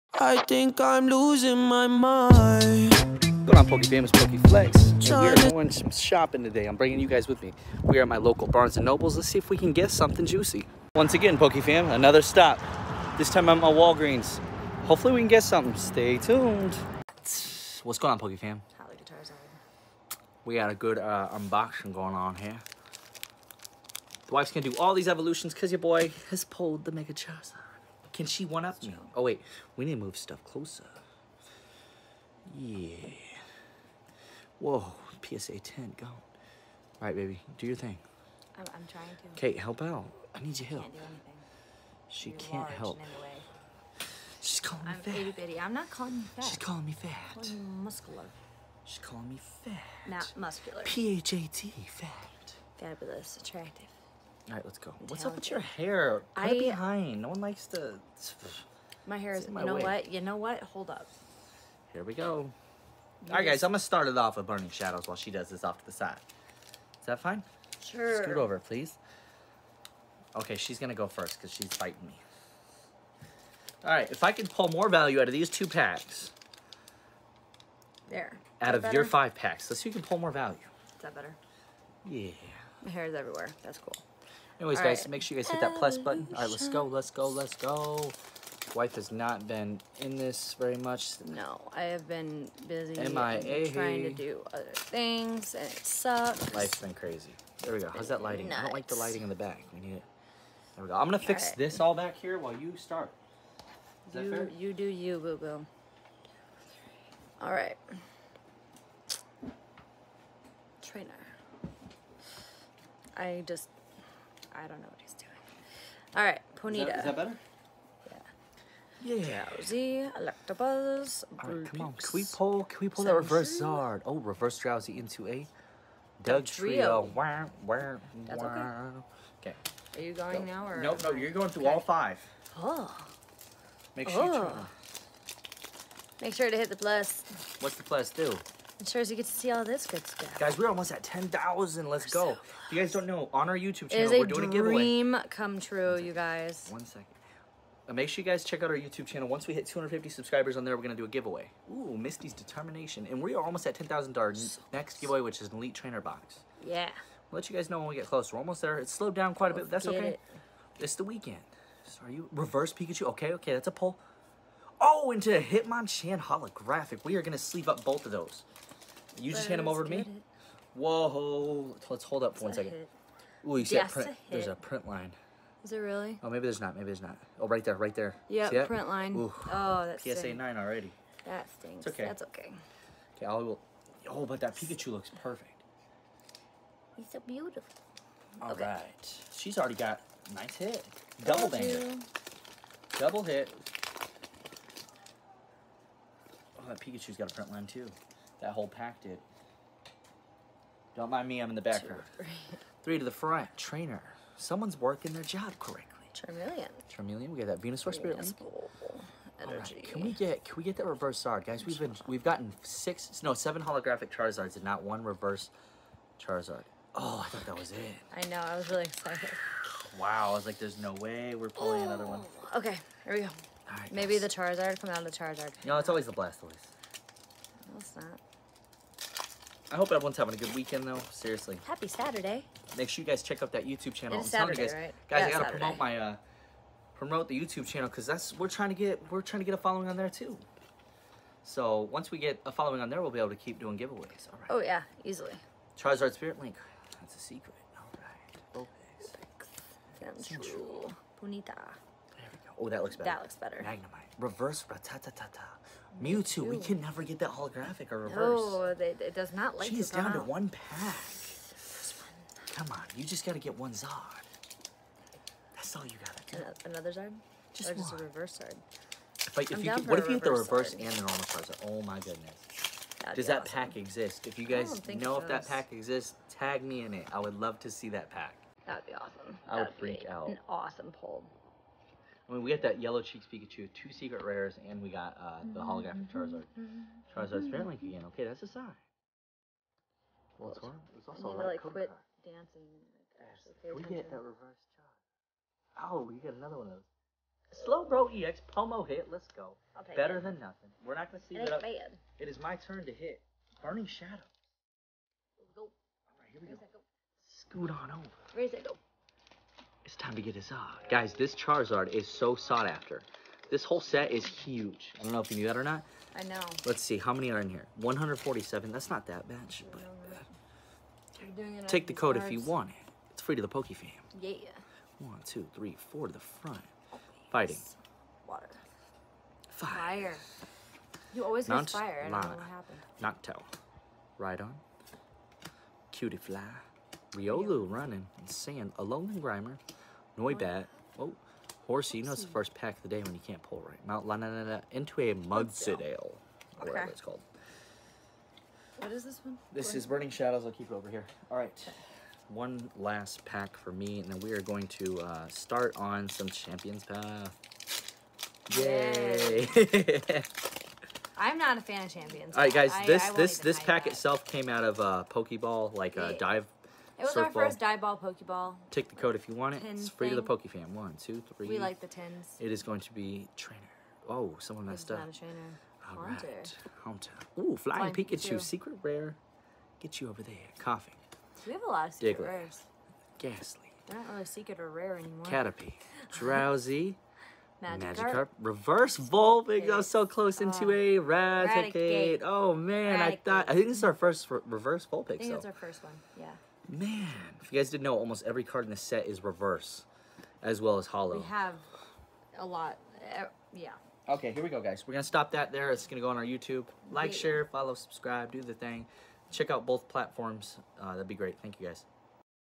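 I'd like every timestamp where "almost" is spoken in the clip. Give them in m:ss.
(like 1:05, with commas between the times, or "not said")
2:20, 2:33, 2:38, 6:37.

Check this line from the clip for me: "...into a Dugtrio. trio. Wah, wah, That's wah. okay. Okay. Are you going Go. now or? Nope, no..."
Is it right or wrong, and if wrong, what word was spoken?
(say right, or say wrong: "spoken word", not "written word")
right.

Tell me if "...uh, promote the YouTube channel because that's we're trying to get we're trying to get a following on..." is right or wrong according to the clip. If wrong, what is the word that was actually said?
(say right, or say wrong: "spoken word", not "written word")
right.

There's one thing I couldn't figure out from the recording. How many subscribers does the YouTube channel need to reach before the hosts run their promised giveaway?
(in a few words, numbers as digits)
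250.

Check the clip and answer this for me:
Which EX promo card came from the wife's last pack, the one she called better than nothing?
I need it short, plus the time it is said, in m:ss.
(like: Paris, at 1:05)
Slowbro EX, at 4:57.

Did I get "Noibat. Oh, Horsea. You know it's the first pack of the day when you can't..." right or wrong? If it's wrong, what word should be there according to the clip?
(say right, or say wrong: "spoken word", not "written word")
right.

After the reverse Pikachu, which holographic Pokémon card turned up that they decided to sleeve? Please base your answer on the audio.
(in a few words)
Hitmonchan.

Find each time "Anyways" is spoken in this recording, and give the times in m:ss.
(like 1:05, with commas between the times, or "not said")
1:24.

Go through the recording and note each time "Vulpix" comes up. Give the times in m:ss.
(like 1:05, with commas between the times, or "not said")
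4:10, 6:28, 6:34.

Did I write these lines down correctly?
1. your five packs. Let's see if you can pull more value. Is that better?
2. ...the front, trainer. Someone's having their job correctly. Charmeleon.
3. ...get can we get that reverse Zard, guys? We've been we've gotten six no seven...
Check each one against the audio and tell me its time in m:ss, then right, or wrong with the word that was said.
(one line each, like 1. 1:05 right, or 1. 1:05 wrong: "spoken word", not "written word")
1. 1:18 right
2. 3:23 wrong: "working", not "having"
3. 3:30 right.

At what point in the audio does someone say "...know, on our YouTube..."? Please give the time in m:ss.
2:23.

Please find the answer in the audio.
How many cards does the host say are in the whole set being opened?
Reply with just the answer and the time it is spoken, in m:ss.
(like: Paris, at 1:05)
147, at 5:17.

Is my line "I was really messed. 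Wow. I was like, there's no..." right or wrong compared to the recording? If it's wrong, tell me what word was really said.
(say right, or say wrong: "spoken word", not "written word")
wrong: "excited", not "messed".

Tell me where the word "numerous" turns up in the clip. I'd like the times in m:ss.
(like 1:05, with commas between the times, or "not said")
not said.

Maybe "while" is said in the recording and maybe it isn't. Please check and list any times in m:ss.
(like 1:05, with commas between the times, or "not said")
1:05, 1:42.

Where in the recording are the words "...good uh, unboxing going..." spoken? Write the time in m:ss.
0:20.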